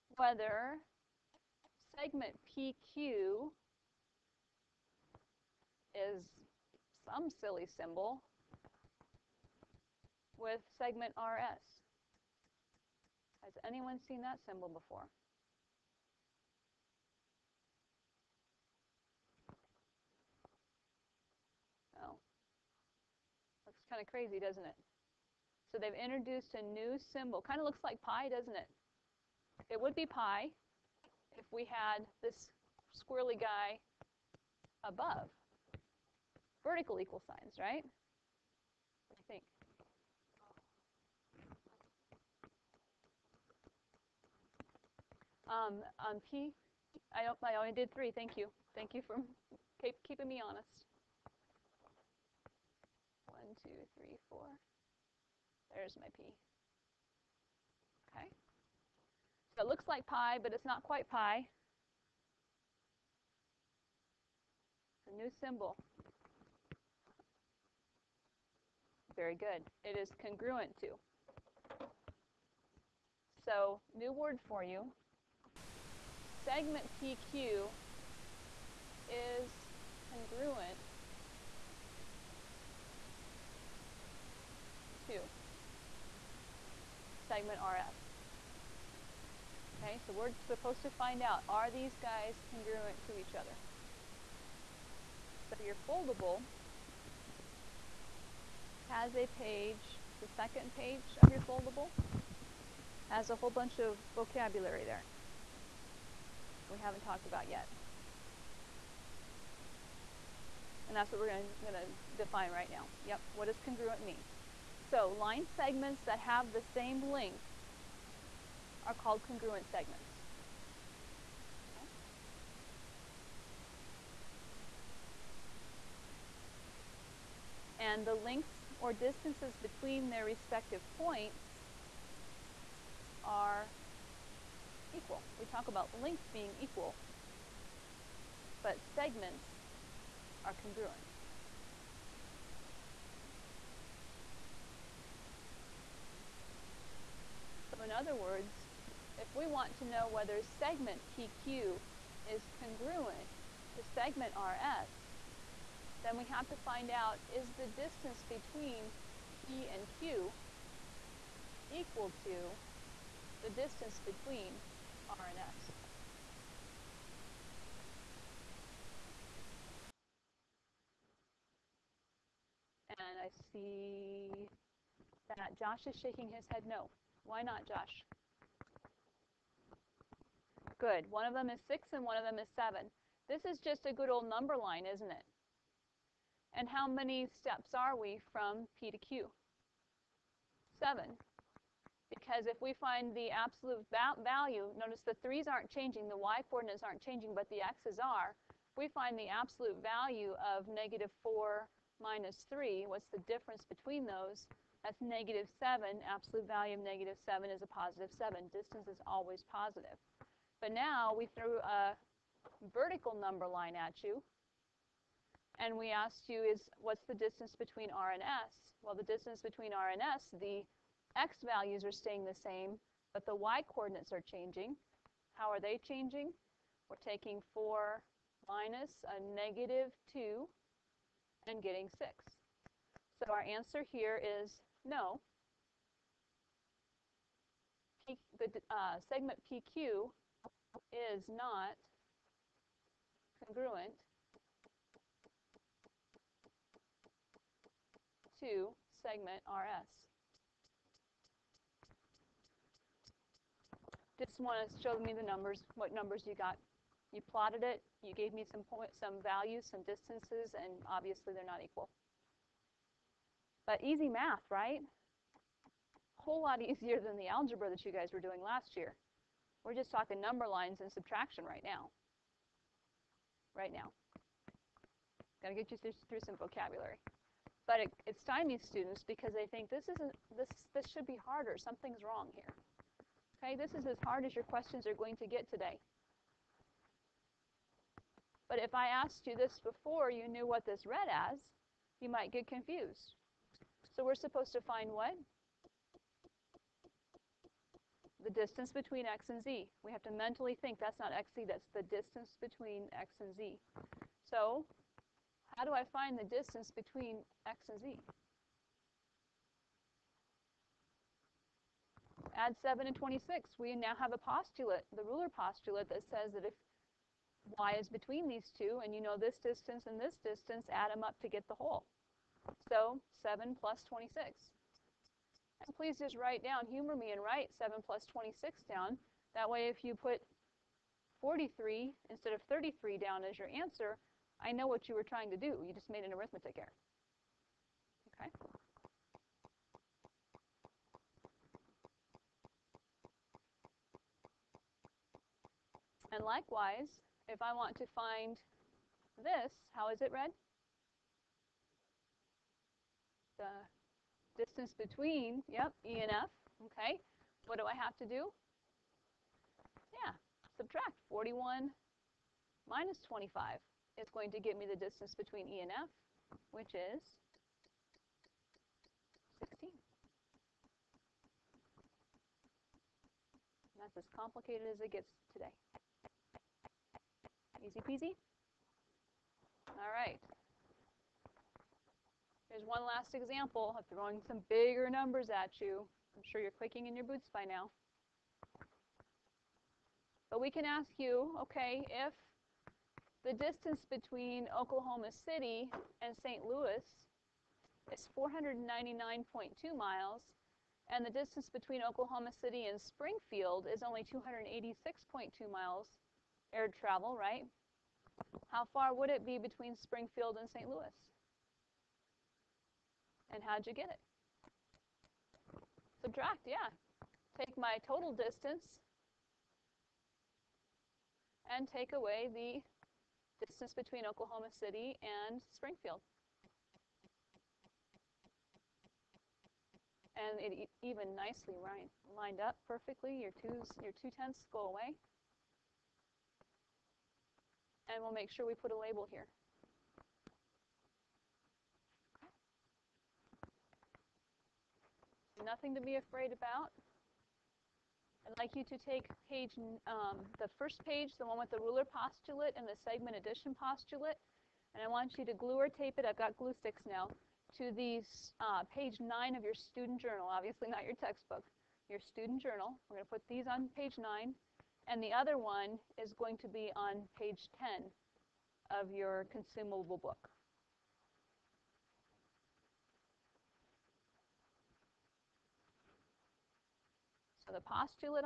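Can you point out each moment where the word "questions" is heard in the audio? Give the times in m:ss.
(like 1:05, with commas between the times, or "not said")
4:44.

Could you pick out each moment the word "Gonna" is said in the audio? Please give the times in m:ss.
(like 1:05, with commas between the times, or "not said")
4:35.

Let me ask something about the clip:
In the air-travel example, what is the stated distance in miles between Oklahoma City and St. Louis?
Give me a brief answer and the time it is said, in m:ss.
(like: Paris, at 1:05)
499.2 miles, at 6:38.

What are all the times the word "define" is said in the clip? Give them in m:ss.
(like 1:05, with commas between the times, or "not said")
1:52.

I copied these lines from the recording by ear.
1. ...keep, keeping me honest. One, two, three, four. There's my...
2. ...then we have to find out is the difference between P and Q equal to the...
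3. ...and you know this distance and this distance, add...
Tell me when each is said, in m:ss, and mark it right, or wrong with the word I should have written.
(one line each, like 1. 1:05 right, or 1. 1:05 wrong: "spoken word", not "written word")
1. 0:49 right
2. 2:36 wrong: "distance", not "difference"
3. 5:18 right.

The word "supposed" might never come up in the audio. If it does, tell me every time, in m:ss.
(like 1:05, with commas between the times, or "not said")
1:30, 4:54.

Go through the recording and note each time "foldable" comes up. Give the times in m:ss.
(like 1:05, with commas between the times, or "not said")
1:35, 1:41.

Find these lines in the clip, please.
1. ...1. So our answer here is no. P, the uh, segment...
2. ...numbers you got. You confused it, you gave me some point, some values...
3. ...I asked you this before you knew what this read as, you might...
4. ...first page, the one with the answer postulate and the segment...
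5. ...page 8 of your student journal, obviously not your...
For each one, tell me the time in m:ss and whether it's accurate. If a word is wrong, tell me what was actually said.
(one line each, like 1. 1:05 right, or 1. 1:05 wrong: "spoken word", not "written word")
1. 3:51 wrong: "6", not "1"
2. 4:15 wrong: "plotted", not "confused"
3. 4:48 right
4. 7:30 wrong: "ruler", not "answer"
5. 7:38 wrong: "9", not "8".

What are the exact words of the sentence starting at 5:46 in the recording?
And likewise, if I want to find this, how is it read?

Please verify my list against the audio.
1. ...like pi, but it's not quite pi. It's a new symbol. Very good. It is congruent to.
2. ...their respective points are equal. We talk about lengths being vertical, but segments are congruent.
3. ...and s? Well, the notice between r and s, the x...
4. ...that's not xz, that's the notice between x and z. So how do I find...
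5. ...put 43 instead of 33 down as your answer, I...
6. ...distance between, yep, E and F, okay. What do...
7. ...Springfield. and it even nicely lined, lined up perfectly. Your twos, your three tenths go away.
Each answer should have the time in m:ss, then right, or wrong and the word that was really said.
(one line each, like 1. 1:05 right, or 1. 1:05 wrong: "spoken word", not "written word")
1. 0:59 right
2. 2:10 wrong: "equal", not "vertical"
3. 3:38 wrong: "distance", not "notice"
4. 5:00 wrong: "distance", not "notice"
5. 5:29 right
6. 5:54 right
7. 7:05 wrong: "two", not "three".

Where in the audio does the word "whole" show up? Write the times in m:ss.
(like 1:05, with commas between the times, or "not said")
1:43, 4:26, 5:21.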